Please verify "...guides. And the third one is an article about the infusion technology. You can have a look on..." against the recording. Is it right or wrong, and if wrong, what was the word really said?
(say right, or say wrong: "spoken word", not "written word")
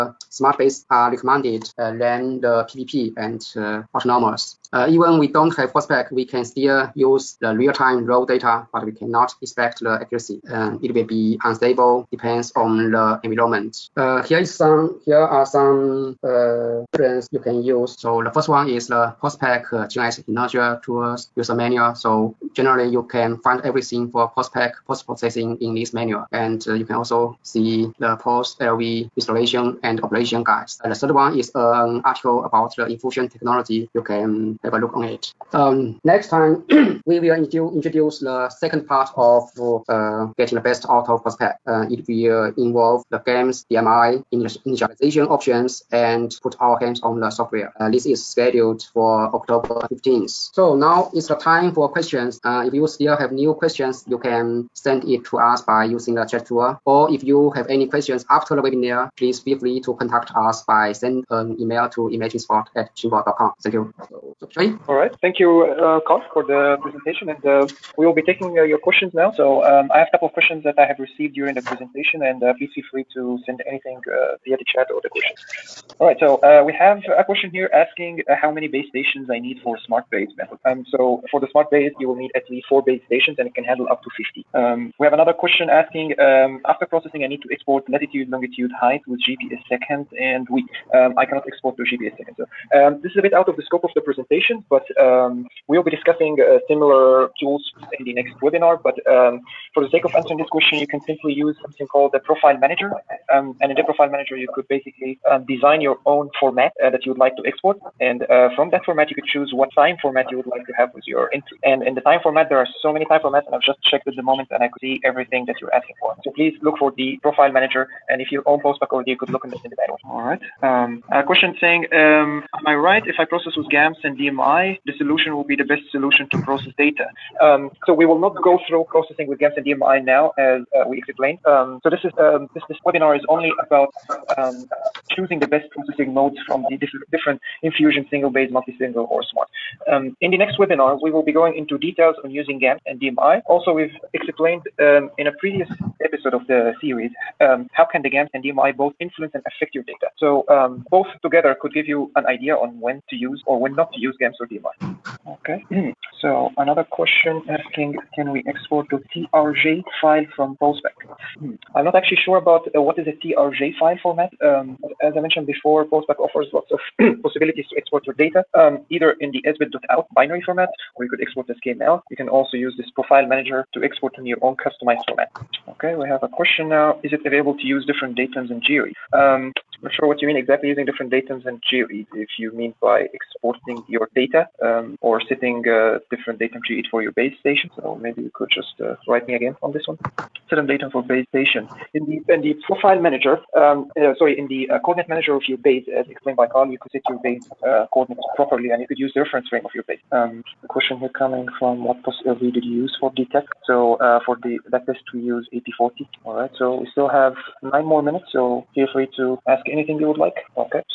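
right.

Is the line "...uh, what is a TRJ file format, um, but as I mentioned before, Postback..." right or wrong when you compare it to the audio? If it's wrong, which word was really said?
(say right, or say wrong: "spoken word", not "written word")
right.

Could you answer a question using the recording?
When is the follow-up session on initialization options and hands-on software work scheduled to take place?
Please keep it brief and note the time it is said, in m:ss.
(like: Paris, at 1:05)
October 15th, at 0:49.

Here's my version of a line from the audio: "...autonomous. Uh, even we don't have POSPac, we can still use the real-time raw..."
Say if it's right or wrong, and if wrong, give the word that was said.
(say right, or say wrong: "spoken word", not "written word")
right.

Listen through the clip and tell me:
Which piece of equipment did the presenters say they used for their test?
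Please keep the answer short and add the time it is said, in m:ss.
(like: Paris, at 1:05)
AP40, at 3:25.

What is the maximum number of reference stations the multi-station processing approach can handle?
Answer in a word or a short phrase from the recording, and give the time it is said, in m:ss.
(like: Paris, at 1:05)
50, at 1:24.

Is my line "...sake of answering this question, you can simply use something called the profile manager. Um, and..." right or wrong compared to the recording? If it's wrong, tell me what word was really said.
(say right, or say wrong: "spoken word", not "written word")
right.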